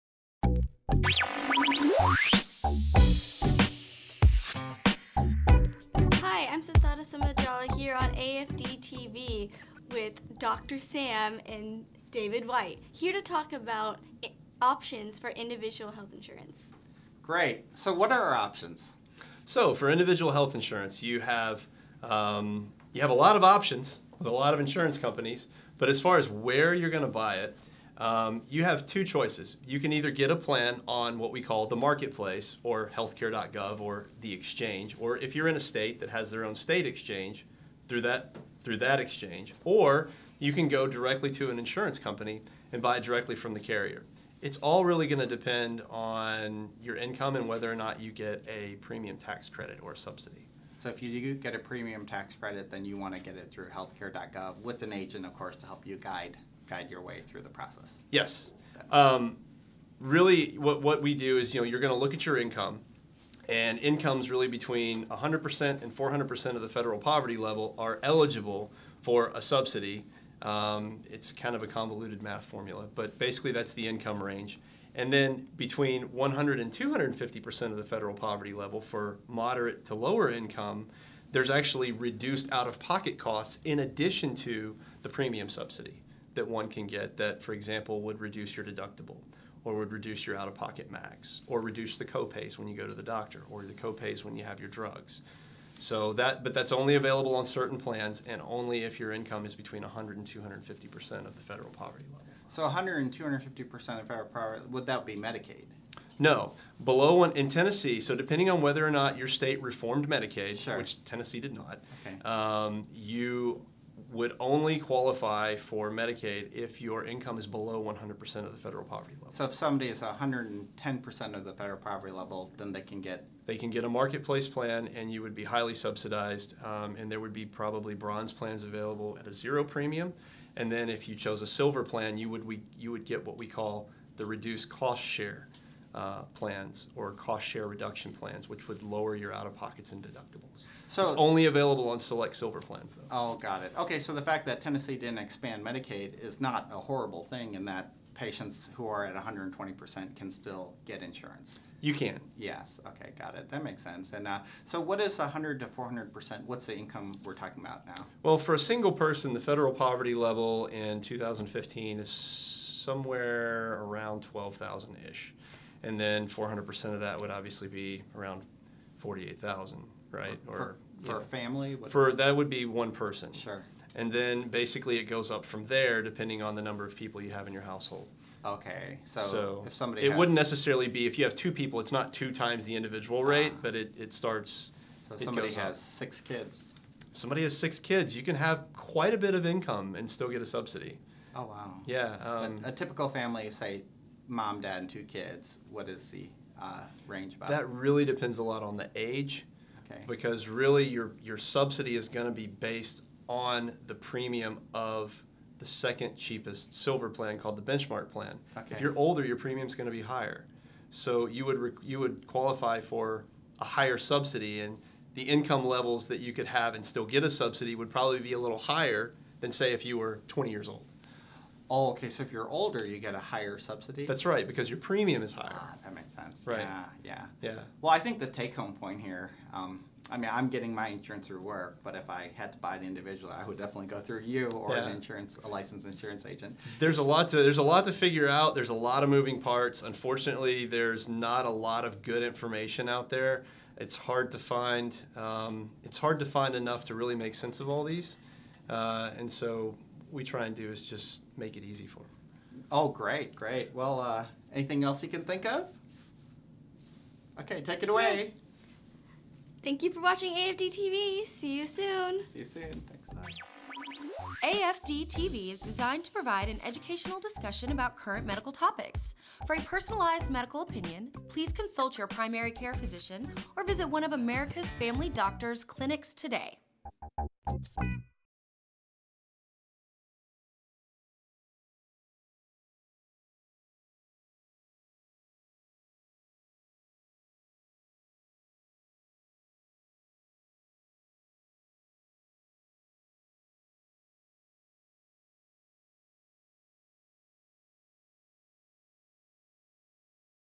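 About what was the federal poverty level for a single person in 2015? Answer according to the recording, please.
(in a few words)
12,000.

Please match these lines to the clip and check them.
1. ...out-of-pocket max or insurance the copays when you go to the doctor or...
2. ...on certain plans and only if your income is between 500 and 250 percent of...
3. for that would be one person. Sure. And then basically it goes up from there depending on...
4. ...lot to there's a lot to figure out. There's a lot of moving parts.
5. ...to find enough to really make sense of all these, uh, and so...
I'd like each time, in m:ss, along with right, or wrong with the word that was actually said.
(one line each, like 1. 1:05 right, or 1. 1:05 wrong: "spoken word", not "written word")
1. 1:30 wrong: "reduce", not "insurance"
2. 1:37 wrong: "100", not "500"
3. 2:51 right
4. 3:57 right
5. 4:06 right.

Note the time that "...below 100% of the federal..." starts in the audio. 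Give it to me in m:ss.
1:57.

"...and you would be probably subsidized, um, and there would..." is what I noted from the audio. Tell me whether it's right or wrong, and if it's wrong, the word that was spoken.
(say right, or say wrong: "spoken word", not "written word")
wrong: "highly", not "probably".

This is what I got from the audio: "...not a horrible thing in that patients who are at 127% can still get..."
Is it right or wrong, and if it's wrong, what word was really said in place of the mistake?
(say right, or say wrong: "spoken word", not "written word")
wrong: "120", not "127".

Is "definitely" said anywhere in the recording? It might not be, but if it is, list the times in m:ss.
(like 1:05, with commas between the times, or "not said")
3:53.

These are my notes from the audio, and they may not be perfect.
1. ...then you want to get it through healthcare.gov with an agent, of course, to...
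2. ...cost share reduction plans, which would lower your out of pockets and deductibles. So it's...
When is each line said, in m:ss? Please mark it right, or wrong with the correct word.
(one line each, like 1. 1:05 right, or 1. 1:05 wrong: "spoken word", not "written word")
1. 0:52 right
2. 2:17 right.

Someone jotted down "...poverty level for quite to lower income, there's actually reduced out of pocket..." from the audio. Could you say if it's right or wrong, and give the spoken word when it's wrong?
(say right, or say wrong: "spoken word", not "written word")
wrong: "moderate", not "quite".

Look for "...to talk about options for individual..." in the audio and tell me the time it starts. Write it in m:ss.
0:13.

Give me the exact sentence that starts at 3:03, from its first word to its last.
rate, uh, but it, it starts.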